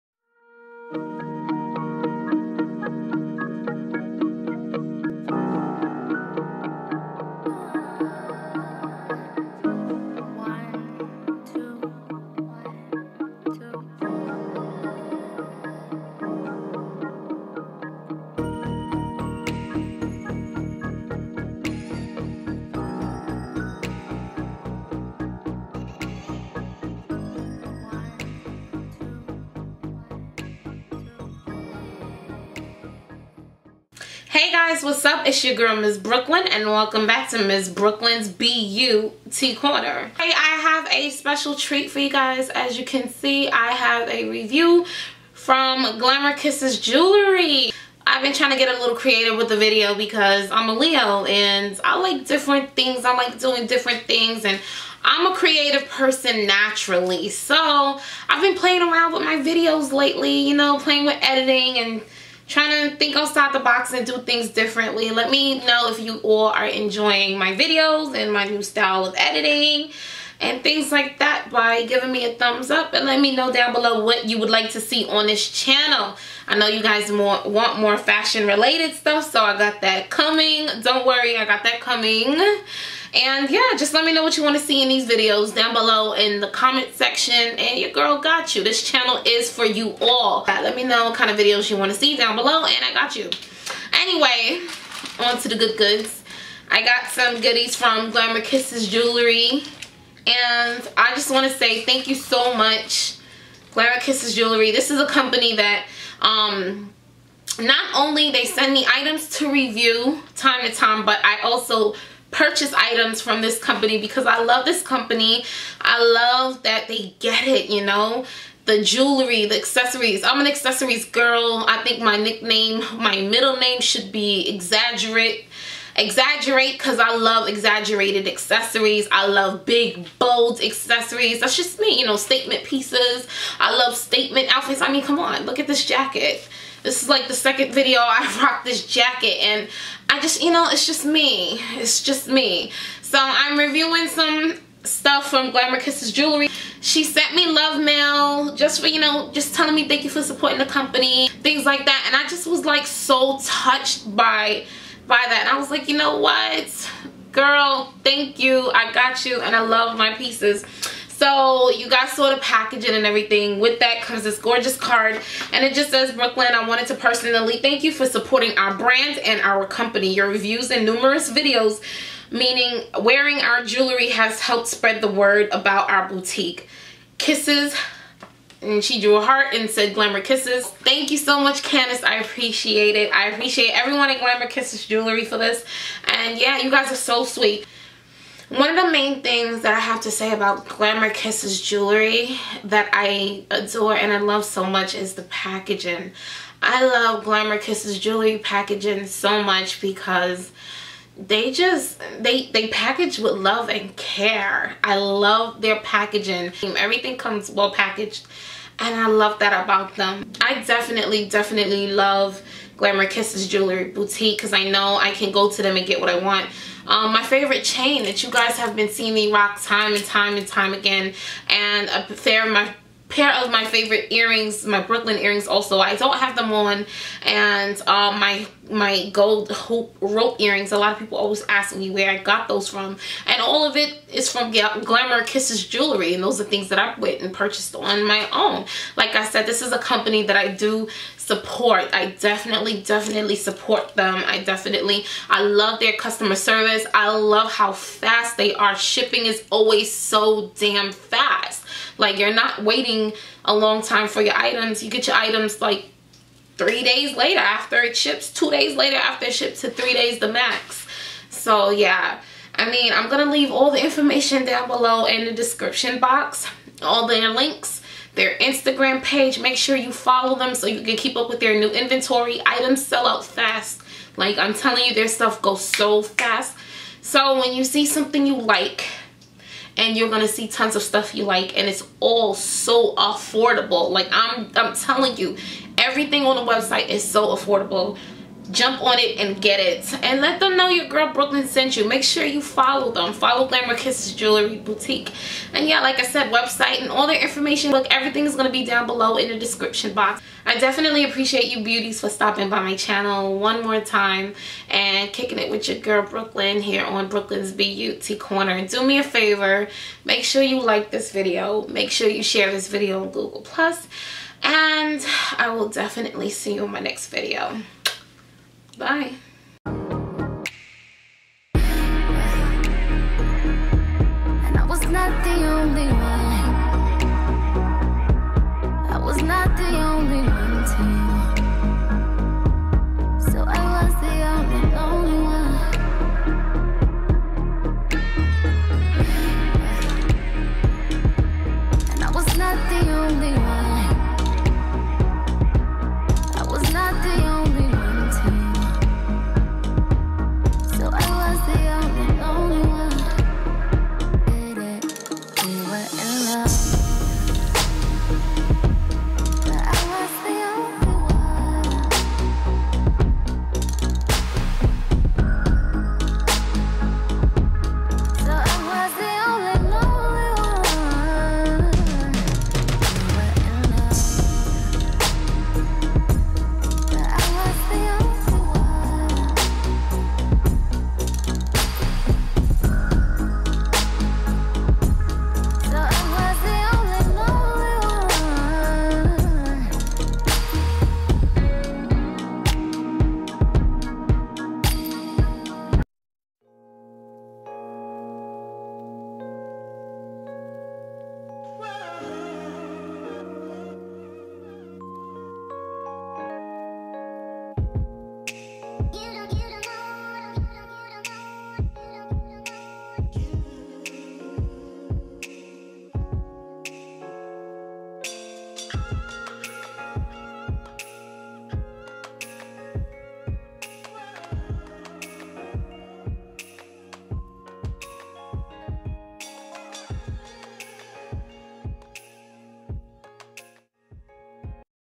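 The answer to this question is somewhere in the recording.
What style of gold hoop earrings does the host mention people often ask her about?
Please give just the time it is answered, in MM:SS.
03:49.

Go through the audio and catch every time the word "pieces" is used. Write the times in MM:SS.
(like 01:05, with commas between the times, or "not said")
02:12, 02:40.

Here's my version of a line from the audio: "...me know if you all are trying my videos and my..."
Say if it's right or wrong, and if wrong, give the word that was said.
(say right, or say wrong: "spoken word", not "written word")
wrong: "enjoying", not "trying".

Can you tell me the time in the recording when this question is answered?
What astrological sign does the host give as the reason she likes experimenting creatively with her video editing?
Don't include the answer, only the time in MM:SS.
00:50.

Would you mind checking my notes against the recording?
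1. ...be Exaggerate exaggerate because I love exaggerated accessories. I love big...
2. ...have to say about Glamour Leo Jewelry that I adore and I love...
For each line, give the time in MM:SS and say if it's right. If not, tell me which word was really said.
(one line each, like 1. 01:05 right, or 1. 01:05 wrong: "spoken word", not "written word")
1. 02:04 right
2. 03:09 wrong: "Kisses", not "Leo".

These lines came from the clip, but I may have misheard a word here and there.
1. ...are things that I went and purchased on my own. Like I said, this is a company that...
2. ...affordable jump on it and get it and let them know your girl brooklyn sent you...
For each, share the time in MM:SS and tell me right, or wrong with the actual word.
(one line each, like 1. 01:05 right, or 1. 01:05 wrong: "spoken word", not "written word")
1. 03:56 right
2. 04:47 right.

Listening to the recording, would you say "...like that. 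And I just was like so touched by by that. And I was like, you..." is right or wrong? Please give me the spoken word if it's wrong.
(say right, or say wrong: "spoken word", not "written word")
right.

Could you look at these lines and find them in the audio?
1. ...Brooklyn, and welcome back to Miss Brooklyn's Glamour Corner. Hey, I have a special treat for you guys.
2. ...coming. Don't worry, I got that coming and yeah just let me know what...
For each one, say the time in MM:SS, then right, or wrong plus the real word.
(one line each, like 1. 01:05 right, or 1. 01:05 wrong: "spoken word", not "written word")
1. 00:35 wrong: "BeYouty", not "Glamour"
2. 01:20 right.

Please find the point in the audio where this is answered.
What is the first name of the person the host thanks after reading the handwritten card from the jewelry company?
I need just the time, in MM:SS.
03:01.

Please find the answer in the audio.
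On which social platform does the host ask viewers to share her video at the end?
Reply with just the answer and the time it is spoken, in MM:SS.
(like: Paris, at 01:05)
Google Plus, at 05:13.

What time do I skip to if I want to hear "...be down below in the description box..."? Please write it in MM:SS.
04:58.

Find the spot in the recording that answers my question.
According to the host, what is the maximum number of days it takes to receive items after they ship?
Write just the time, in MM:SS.
04:19.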